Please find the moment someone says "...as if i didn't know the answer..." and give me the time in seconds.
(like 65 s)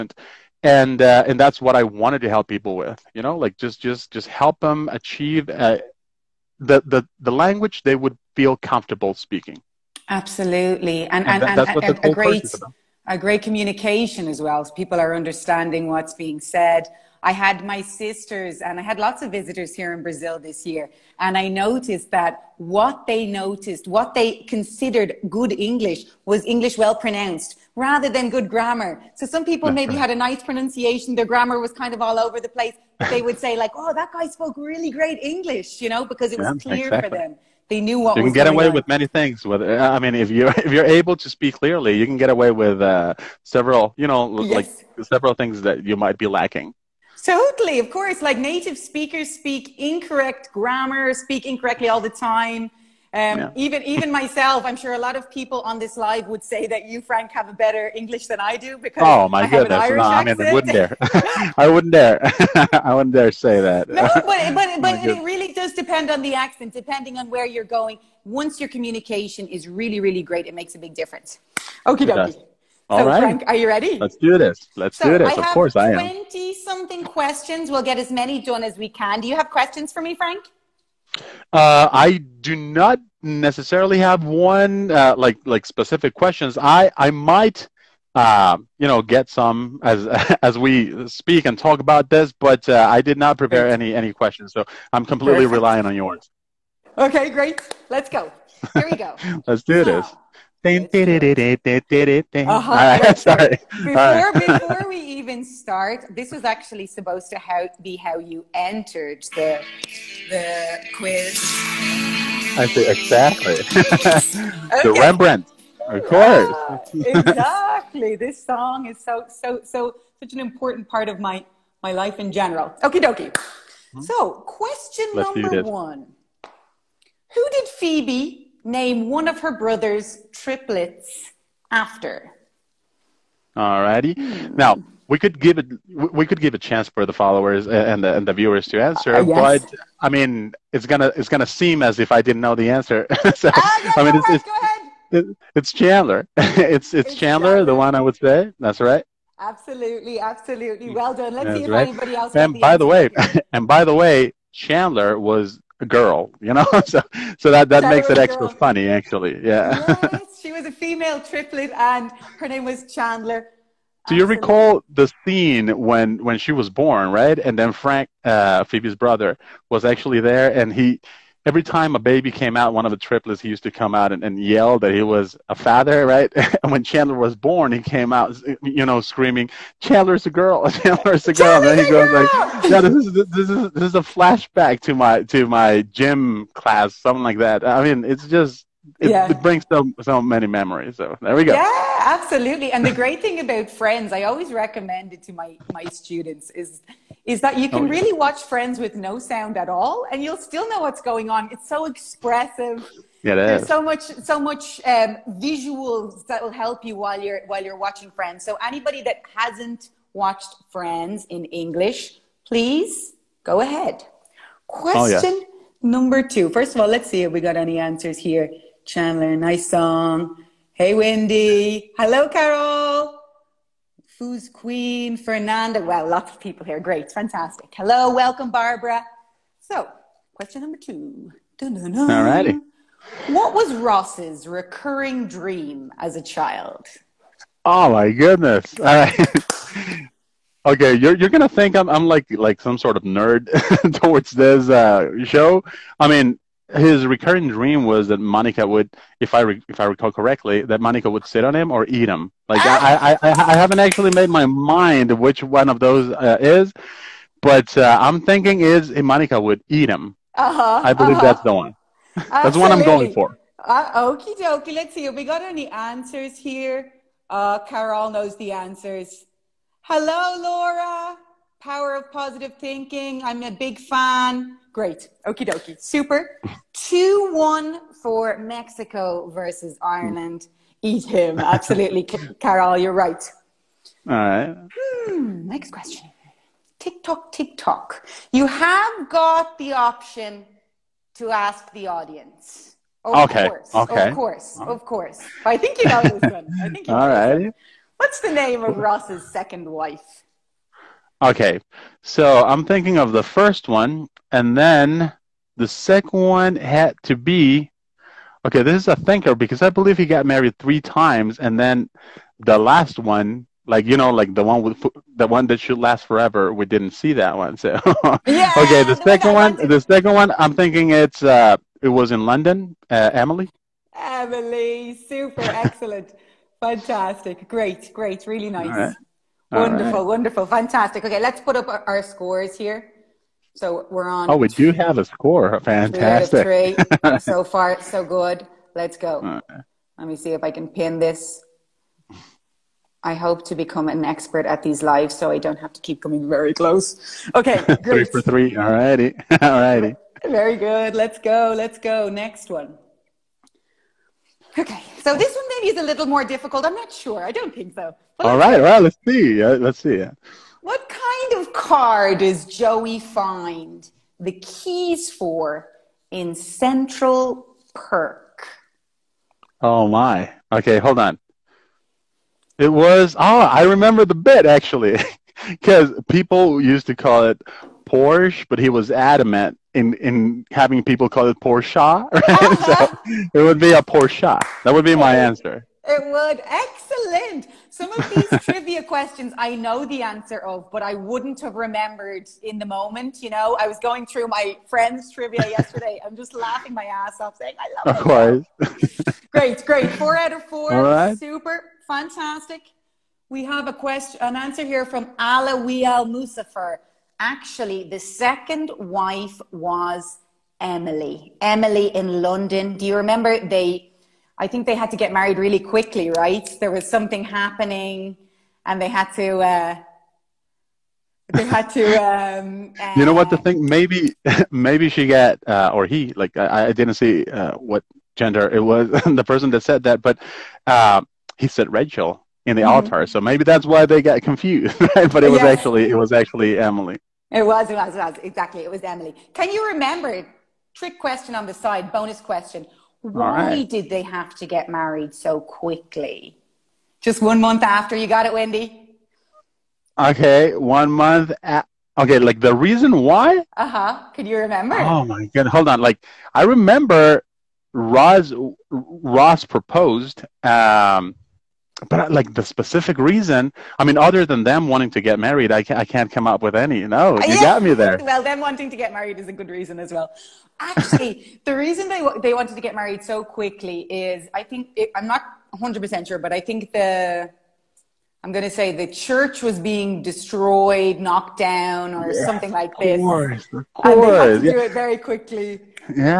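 141 s.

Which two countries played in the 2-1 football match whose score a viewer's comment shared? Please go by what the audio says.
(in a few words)
Mexico versus Ireland.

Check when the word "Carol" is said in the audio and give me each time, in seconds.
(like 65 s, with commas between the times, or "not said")
222 s, 267 s, 282 s.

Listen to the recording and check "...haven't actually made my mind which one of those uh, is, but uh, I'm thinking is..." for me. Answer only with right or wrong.
right.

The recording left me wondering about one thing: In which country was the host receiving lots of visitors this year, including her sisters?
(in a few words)
Brazil.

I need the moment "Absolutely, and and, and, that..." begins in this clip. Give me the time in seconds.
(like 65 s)
10 s.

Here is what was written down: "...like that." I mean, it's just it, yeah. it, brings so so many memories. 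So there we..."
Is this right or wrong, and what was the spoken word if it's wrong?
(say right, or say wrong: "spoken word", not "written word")
right.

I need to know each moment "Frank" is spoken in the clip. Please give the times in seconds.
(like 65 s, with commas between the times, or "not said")
57 s, 73 s, 80 s, 167 s.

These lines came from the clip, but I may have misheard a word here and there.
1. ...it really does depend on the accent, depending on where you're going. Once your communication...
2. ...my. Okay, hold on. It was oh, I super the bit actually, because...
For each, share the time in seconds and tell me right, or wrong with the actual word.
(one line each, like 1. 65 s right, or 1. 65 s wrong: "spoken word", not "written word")
1. 65 s right
2. 369 s wrong: "remember", not "super".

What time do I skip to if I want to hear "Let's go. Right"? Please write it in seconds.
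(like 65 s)
338 s.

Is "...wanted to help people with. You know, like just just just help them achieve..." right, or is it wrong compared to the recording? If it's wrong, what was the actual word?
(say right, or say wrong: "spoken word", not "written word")
right.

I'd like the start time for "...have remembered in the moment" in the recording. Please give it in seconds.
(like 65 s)
391 s.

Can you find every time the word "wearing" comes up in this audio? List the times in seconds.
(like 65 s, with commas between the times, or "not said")
not said.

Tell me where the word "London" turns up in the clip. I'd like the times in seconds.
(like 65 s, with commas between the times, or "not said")
322 s, 412 s.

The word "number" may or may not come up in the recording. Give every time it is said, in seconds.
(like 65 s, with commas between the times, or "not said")
125 s, 215 s, 230 s.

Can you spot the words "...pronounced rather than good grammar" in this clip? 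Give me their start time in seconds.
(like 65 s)
26 s.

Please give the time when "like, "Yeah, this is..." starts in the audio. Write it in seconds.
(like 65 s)
182 s.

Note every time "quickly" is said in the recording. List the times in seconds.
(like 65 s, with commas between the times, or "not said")
415 s, 445 s, 473 s, 484 s.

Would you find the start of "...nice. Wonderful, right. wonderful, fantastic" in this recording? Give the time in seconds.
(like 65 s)
328 s.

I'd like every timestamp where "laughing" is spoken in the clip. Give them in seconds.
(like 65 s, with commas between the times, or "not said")
396 s.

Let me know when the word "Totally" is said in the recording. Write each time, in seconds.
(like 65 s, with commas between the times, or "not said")
47 s.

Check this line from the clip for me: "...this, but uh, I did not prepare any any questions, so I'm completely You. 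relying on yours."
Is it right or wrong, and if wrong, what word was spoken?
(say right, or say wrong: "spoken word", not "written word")
wrong: "Perfect", not "You".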